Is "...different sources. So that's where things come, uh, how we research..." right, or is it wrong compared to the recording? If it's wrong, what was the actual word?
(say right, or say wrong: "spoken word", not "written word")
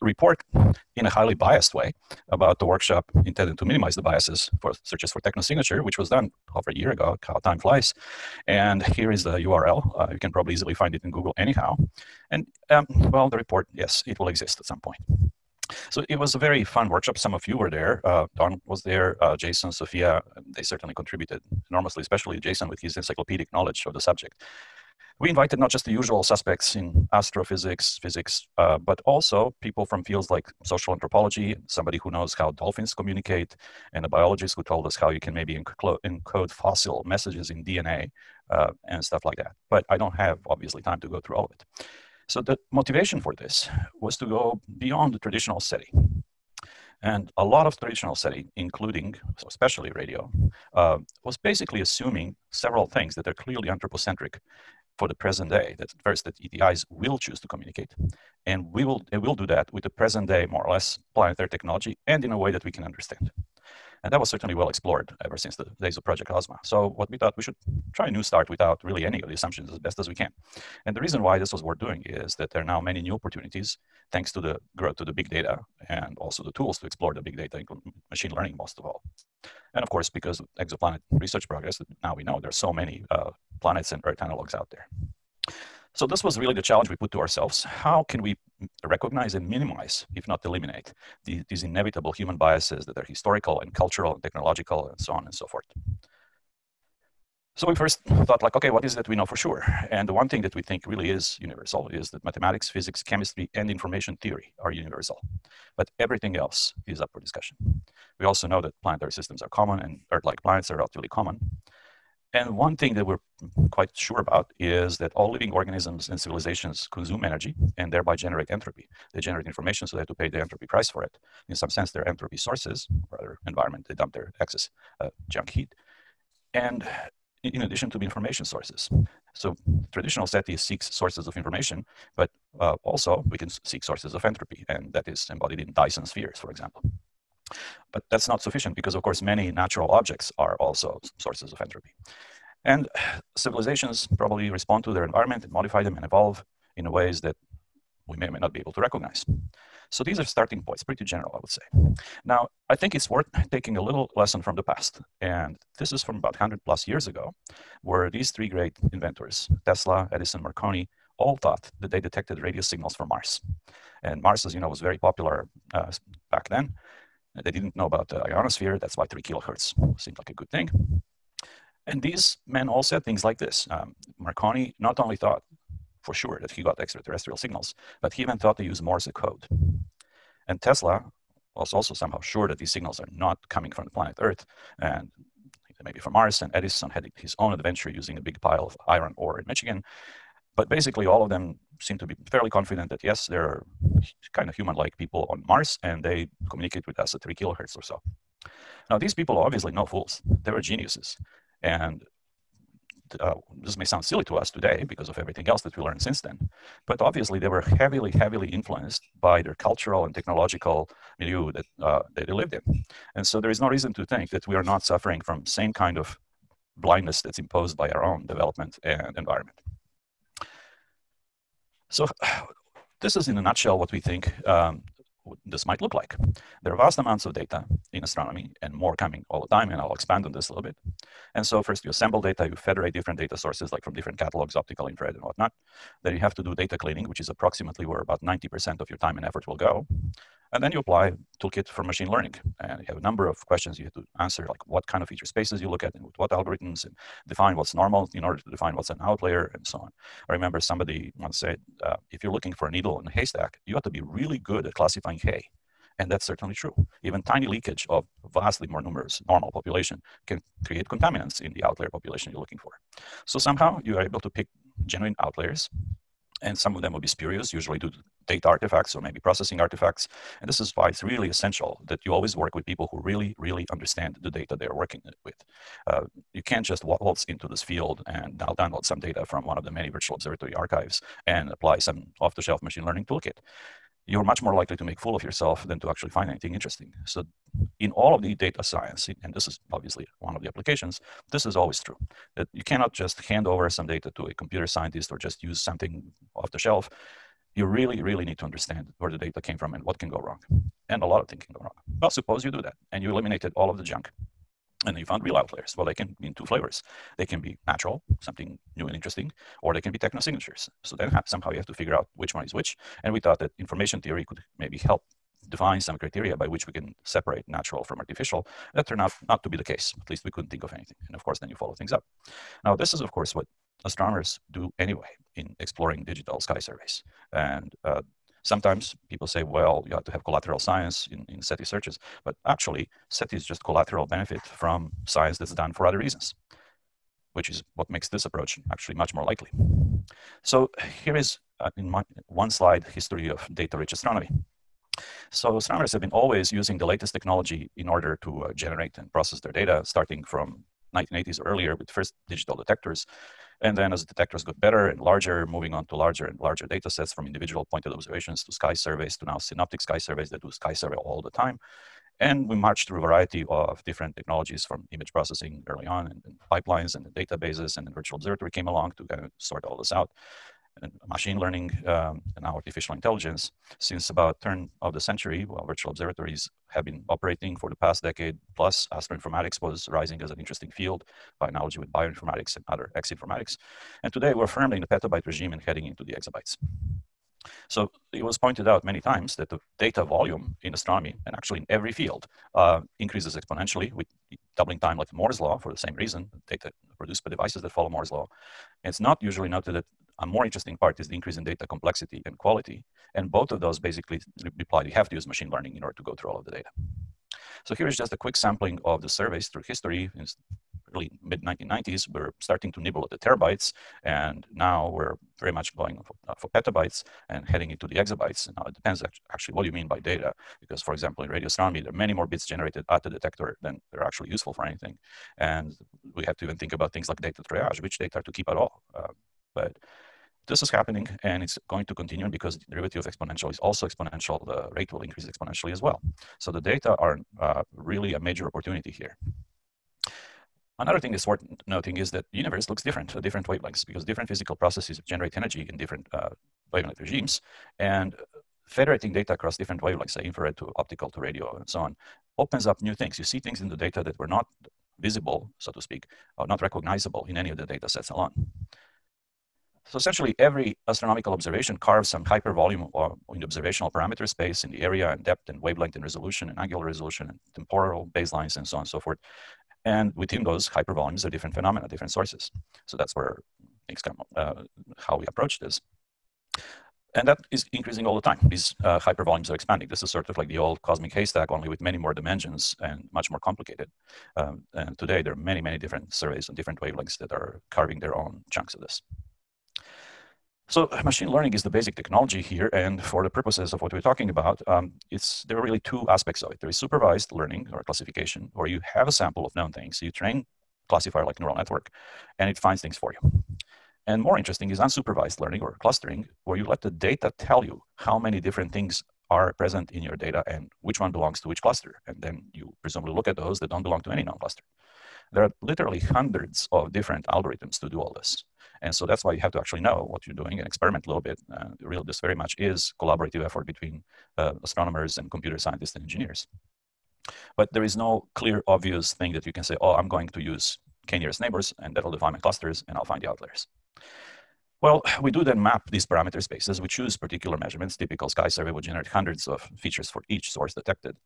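wrong: "approach", not "research".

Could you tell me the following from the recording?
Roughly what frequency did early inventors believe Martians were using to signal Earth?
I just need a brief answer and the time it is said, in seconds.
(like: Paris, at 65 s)
3 kilohertz, at 169 s.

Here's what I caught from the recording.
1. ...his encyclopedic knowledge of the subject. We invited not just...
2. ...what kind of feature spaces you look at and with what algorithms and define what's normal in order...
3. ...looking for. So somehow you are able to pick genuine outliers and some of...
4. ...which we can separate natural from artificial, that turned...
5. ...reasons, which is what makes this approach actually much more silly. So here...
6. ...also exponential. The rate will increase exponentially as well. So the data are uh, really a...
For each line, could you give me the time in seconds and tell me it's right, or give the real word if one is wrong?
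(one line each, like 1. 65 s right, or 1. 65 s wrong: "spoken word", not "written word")
1. 22 s right
2. 244 s right
3. 262 s right
4. 316 s right
5. 335 s wrong: "likely", not "silly"
6. 433 s right.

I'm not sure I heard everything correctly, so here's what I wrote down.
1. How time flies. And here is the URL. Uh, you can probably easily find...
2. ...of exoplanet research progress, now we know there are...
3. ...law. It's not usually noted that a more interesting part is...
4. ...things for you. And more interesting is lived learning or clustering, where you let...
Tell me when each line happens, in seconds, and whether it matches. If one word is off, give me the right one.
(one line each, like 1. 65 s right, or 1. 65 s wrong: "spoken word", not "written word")
1. 7 s right
2. 80 s right
3. 398 s right
4. 502 s wrong: "unsupervised", not "lived".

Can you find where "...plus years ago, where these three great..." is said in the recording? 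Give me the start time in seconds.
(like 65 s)
156 s.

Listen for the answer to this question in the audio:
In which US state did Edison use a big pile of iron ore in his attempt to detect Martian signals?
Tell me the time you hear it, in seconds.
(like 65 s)
189 s.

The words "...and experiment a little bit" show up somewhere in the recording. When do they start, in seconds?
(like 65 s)
520 s.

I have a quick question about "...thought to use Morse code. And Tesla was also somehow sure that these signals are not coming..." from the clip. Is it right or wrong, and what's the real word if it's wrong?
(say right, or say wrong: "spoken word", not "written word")
right.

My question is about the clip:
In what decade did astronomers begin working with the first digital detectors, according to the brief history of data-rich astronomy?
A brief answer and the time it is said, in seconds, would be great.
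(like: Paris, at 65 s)
1980s, at 350 s.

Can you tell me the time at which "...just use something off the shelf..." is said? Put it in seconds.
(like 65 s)
295 s.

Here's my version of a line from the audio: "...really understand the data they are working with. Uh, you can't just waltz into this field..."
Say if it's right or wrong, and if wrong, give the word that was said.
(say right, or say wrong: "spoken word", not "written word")
right.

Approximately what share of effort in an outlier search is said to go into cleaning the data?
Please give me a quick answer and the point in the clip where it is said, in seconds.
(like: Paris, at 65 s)
90%, at 238 s.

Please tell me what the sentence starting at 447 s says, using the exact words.
And uh, federating data across different wavelengths, say infrared to optical to radio and so on, opens up new things.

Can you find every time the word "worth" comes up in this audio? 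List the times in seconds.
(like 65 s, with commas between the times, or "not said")
71 s, 153 s, 441 s.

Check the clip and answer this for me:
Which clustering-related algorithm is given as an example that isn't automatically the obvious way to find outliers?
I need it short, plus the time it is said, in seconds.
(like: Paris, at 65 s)
k-nearest neighbors, at 531 s.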